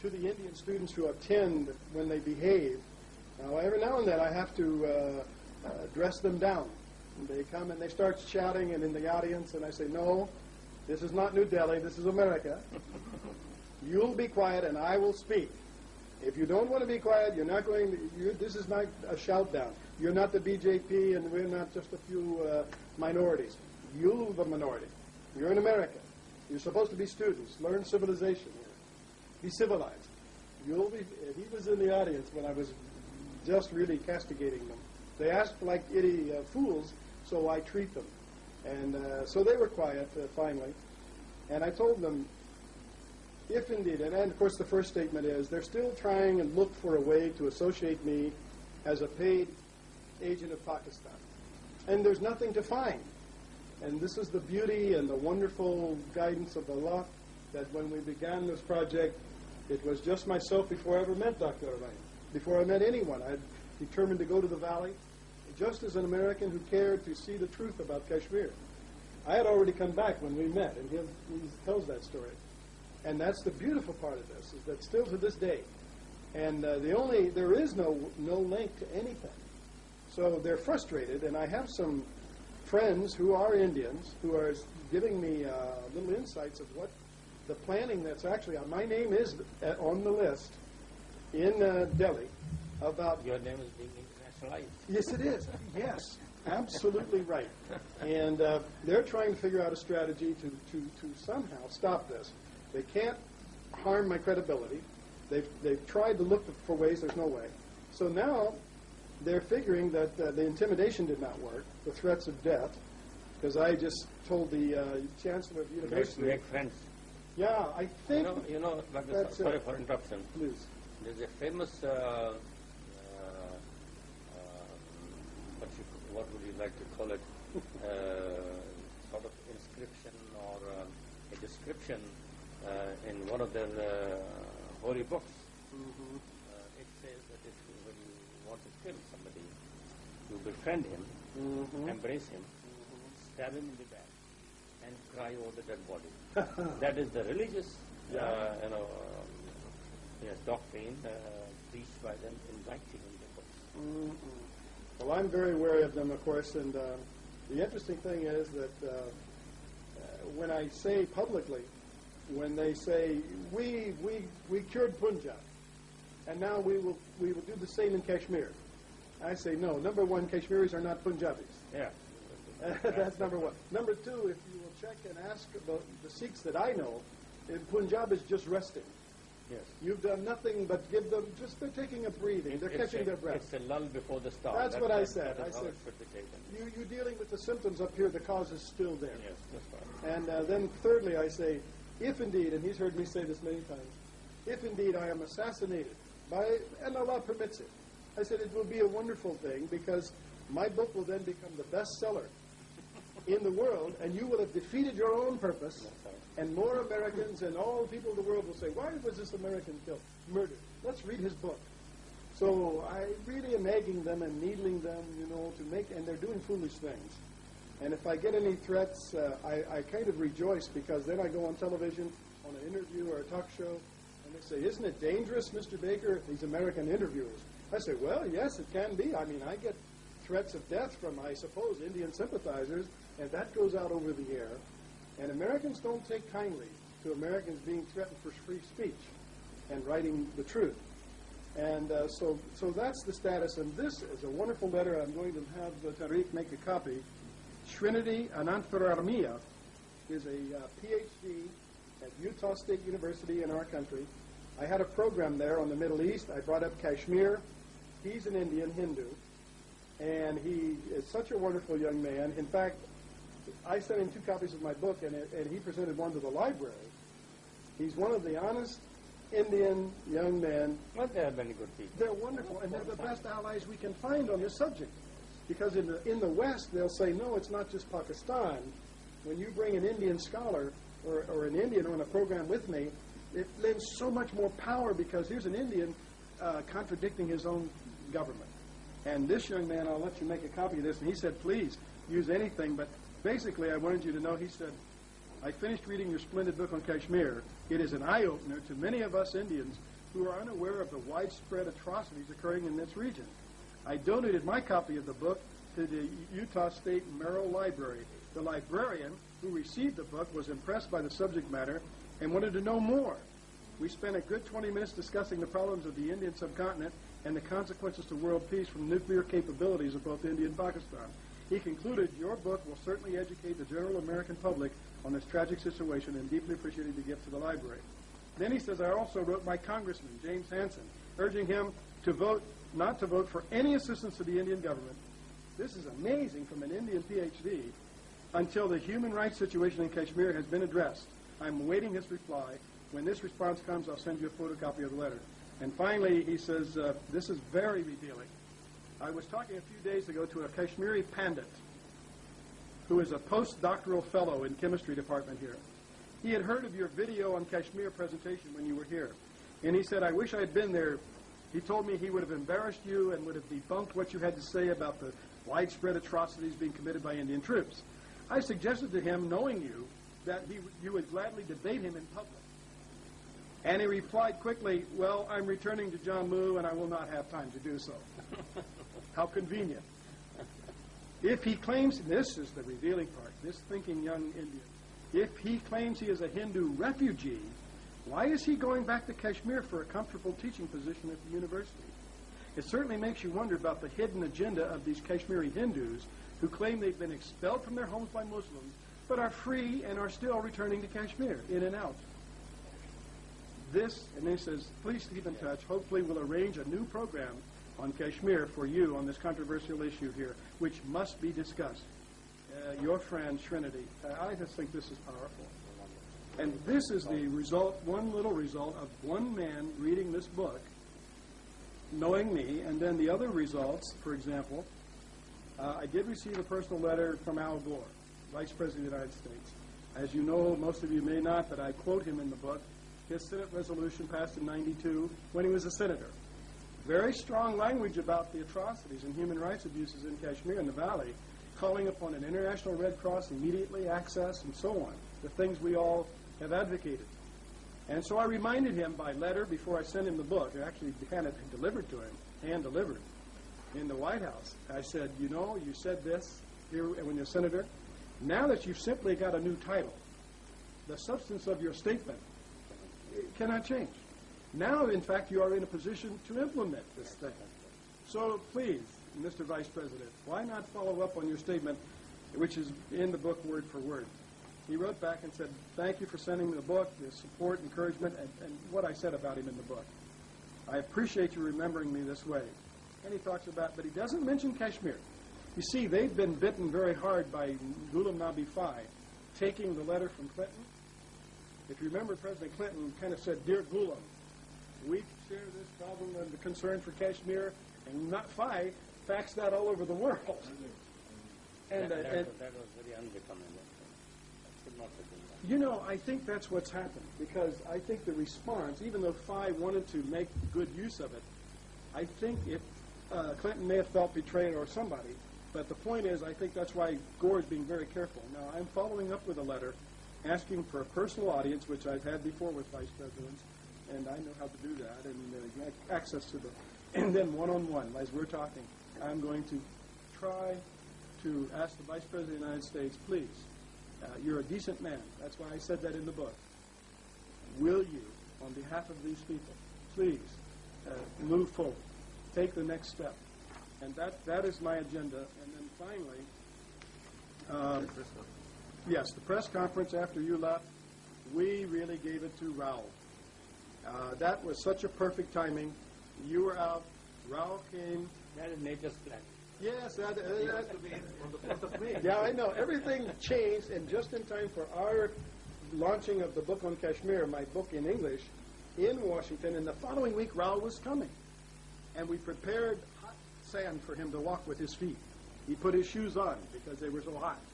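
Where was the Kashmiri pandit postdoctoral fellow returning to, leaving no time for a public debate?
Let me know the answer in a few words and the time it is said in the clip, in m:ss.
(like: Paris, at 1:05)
Jammu, at 6:15.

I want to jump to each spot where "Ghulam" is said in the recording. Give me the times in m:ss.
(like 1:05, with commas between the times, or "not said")
8:07, 8:13.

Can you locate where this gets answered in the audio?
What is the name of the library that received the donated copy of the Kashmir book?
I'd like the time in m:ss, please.
5:07.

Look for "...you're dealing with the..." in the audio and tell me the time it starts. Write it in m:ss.
3:06.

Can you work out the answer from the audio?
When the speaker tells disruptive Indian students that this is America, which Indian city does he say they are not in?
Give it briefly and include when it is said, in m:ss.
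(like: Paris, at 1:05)
New Delhi, at 0:11.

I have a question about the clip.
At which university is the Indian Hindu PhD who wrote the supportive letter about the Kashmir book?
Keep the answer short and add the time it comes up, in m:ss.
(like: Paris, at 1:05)
Utah State University, at 4:12.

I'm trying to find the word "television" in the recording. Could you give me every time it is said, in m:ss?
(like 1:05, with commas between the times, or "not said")
3:41.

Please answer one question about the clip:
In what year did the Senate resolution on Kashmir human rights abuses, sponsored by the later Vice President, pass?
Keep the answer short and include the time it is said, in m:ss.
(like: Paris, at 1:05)
1992, at 7:14.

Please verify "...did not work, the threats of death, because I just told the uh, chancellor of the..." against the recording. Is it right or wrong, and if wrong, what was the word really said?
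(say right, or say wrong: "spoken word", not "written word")
right.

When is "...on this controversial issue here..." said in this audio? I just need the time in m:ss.
6:48.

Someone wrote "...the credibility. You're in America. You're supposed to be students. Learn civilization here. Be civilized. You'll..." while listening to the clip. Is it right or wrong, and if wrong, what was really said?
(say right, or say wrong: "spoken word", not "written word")
wrong: "minority", not "credibility".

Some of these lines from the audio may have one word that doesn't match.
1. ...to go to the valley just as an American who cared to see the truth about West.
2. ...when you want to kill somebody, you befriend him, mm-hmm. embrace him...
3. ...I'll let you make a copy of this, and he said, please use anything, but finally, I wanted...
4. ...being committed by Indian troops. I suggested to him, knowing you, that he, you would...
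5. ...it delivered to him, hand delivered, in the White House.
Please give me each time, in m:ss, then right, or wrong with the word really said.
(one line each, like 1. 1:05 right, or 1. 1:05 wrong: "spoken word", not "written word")
1. 1:04 wrong: "Kashmir", not "West"
2. 2:17 right
3. 4:49 wrong: "basically", not "finally"
4. 6:06 right
5. 7:31 right.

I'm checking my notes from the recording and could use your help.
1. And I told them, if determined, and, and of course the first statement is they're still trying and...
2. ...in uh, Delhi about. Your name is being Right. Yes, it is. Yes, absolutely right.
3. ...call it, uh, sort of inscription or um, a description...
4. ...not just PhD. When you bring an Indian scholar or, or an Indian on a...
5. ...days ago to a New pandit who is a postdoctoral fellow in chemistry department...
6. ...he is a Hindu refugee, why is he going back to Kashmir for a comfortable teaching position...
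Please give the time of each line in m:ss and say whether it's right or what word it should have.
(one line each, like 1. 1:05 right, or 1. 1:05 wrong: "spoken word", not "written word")
1. 0:41 wrong: "indeed", not "determined"
2. 1:31 right
3. 2:06 right
4. 4:37 wrong: "Pakistan", not "PhD"
5. 5:49 wrong: "Kashmiri", not "New"
6. 6:25 right.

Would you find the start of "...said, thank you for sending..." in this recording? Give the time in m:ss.
7:55.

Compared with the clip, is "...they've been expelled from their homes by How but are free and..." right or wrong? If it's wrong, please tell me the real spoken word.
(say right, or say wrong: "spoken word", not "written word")
wrong: "Muslims", not "How".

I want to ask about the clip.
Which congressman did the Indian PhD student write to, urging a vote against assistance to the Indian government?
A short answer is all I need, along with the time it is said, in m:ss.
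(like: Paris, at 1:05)
James Hansen, at 5:30.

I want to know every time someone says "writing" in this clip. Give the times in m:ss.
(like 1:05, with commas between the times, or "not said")
2:32, 3:59.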